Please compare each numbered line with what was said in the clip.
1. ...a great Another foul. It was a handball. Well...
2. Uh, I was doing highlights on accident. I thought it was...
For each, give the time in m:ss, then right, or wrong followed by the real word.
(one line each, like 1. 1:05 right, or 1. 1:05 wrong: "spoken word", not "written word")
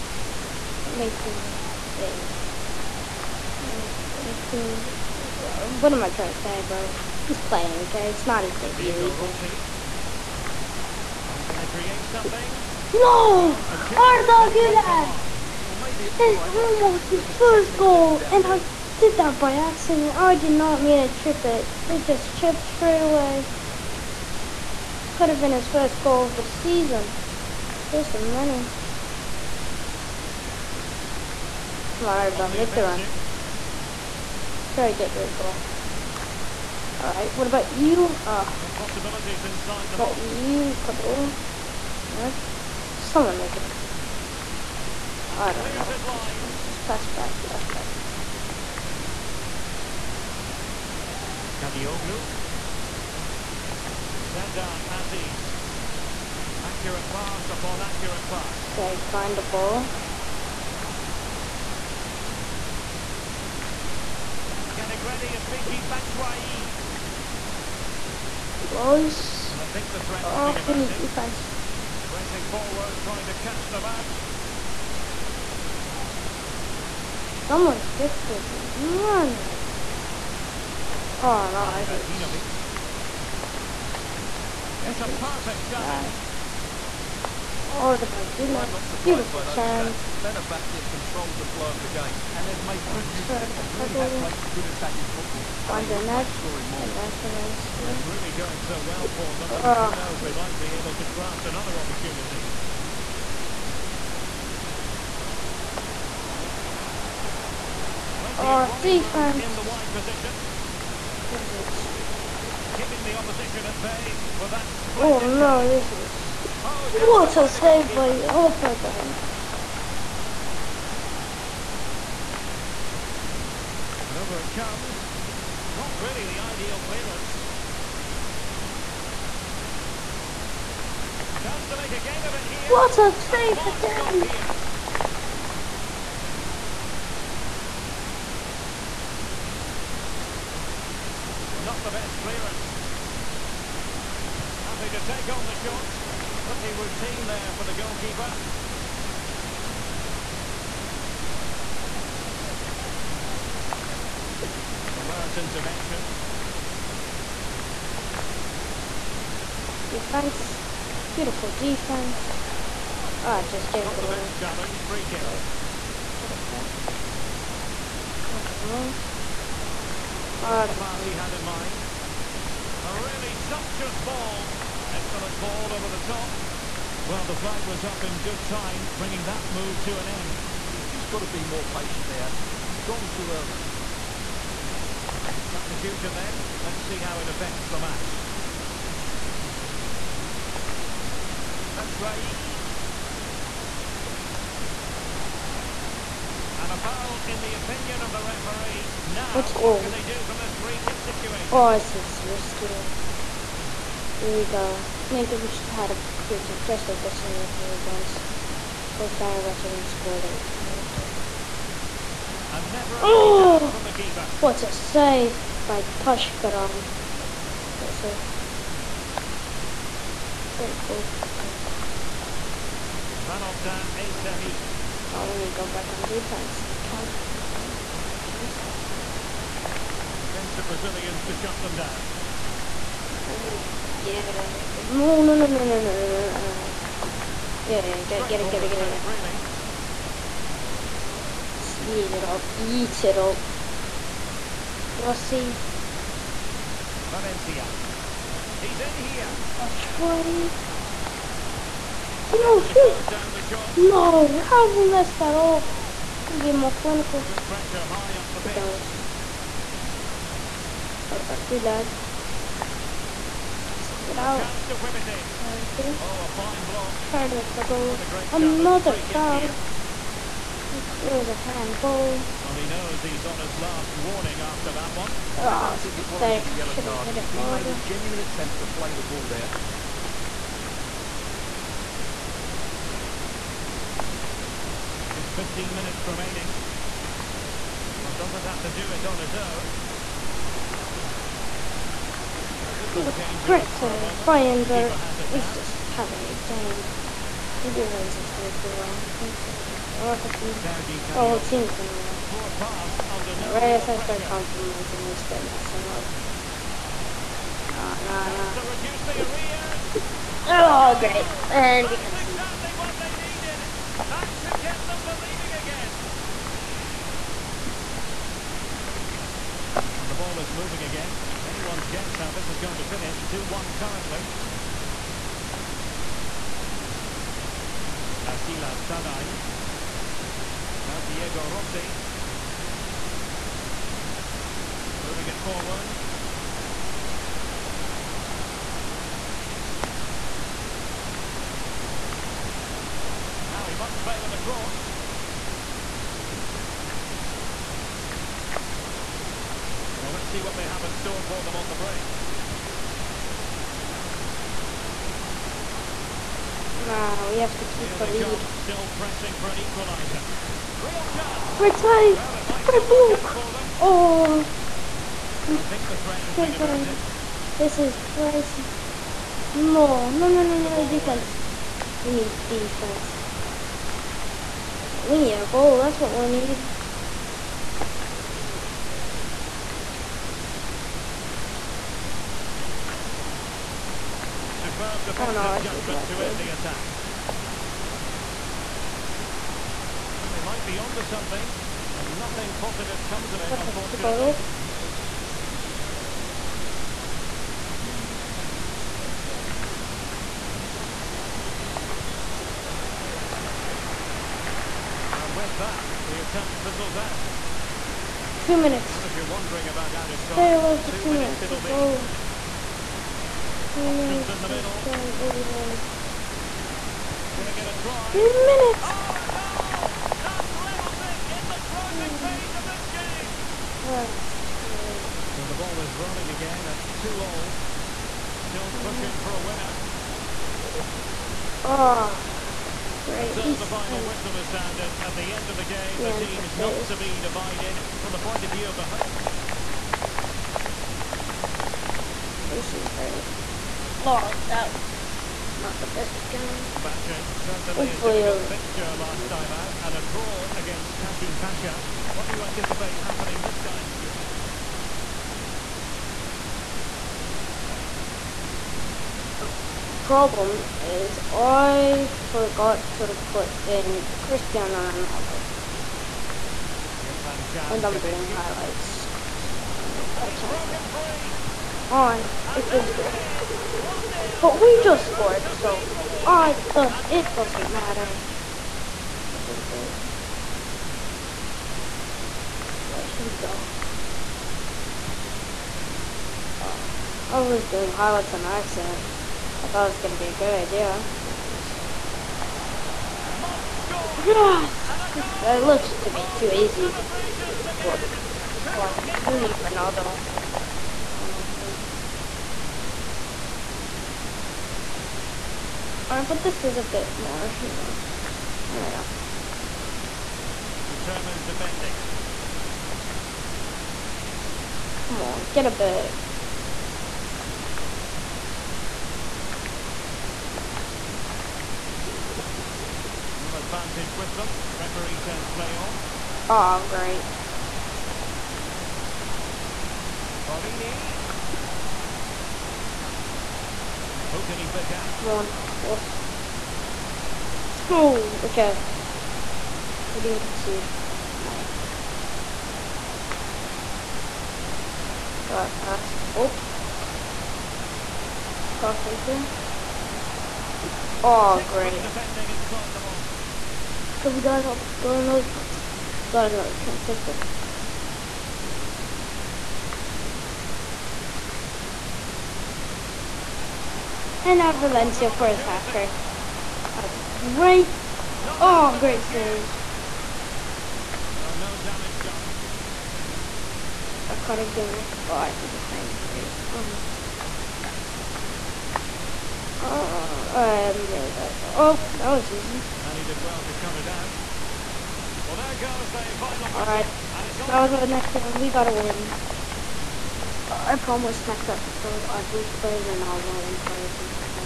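1. 4:28 right
2. 8:06 right.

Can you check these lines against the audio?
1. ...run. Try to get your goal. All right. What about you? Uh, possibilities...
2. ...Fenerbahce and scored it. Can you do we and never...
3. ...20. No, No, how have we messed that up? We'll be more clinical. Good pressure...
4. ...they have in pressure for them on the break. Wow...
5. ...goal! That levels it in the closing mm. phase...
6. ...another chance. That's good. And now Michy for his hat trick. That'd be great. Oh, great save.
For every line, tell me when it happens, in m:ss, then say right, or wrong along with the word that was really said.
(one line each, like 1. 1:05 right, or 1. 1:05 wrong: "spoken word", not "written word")
1. 0:32 right
2. 3:29 right
3. 4:09 right
4. 5:50 wrong: "store", not "pressure"
5. 6:59 right
6. 9:16 wrong: "Valencia", not "Michy".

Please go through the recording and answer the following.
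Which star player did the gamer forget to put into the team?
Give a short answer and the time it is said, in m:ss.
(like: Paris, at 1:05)
Cristiano Ronaldo, at 7:44.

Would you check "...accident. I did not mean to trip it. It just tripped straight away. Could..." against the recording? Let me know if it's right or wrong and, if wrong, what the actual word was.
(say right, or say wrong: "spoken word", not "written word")
right.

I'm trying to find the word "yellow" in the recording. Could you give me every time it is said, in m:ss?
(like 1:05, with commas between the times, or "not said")
4:36.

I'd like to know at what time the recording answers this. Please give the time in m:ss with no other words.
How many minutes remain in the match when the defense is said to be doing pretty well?
4:45.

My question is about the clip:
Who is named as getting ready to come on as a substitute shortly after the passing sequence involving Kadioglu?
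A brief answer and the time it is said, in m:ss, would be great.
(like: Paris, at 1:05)
Michy Batshuayi, at 1:05.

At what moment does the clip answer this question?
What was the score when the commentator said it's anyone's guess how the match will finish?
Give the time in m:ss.
5:23.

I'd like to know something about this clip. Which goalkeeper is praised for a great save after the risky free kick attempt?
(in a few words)
Taşkıran.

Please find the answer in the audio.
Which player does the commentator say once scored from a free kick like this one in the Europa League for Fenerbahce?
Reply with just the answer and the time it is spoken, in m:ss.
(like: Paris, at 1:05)
Lincoln, at 3:25.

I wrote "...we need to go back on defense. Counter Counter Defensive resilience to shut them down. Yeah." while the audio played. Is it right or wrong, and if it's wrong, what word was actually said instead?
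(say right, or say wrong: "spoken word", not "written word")
right.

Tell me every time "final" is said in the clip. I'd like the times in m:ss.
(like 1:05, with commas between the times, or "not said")
7:13, 9:46.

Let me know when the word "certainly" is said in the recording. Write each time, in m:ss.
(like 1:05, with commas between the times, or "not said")
7:27.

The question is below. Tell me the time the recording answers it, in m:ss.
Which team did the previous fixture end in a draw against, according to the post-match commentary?
7:30.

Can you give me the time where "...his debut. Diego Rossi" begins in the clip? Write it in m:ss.
0:08.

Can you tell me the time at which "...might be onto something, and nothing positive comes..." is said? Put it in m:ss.
6:30.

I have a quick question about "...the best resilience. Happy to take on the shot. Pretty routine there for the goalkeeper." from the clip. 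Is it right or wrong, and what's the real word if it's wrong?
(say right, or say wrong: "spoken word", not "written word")
wrong: "clearance", not "resilience".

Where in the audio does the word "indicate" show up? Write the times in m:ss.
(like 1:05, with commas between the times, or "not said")
not said.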